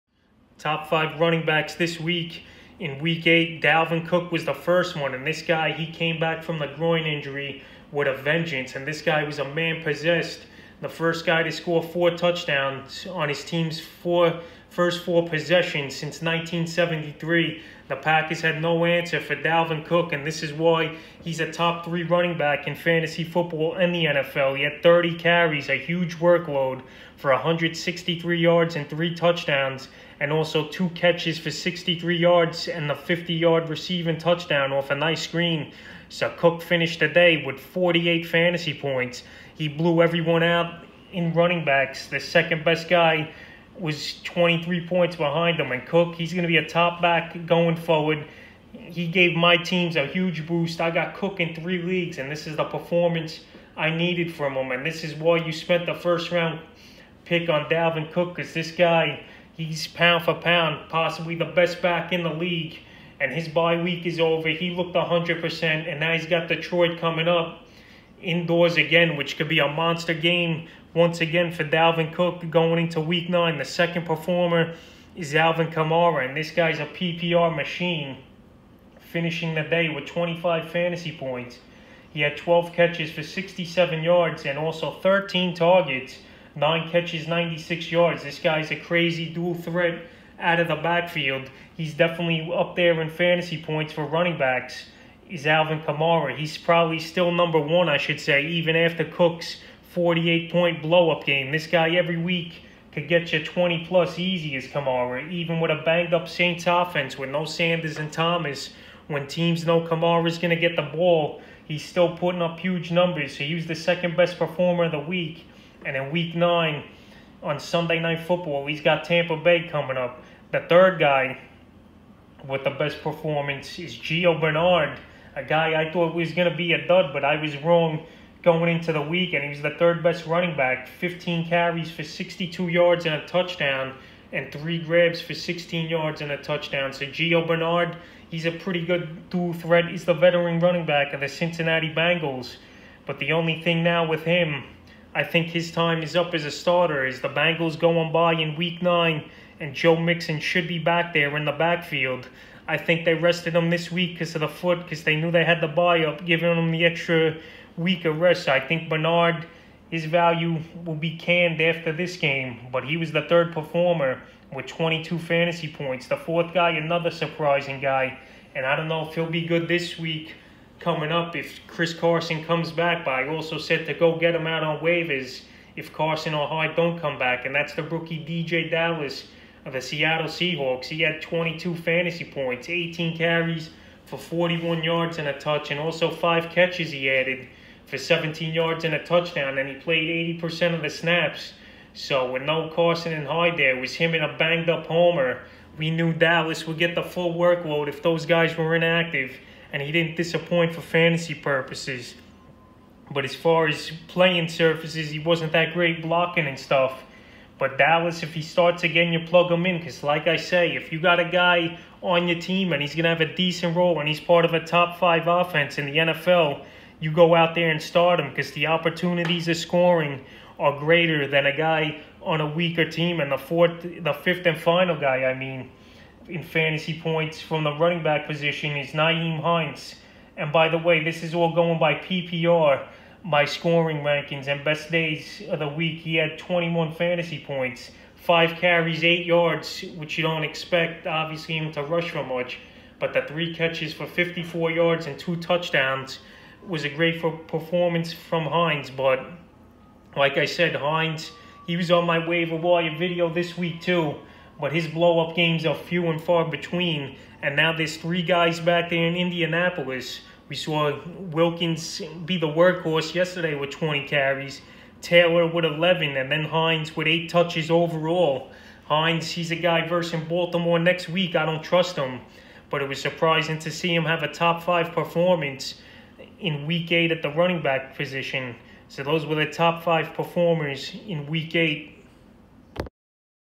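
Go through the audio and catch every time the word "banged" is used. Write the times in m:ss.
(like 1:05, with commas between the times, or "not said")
1:45, 3:14.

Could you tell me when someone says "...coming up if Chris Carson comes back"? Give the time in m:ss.
2:50.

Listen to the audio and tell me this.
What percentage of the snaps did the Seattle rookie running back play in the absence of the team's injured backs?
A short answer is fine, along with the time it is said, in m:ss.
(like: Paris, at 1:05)
80%, at 3:10.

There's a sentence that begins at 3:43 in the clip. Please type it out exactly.
And the fourth, the fifth and final guy, I mean, in fantasy points from the running back position is Nyheim Hines.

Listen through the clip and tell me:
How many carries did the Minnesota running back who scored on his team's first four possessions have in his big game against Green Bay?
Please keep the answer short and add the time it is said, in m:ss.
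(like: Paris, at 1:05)
30, at 0:24.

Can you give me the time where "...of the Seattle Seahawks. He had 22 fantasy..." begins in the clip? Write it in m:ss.
2:59.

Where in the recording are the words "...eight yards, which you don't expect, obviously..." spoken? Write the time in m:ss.
3:59.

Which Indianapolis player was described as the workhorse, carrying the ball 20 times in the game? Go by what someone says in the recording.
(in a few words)
Wilkins.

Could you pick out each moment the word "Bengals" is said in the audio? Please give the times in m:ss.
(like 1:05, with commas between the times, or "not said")
2:21, 2:27.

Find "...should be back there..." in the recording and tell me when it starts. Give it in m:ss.
2:30.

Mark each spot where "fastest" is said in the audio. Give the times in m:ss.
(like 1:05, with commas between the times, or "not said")
not said.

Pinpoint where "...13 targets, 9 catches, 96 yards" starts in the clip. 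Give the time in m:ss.
1:24.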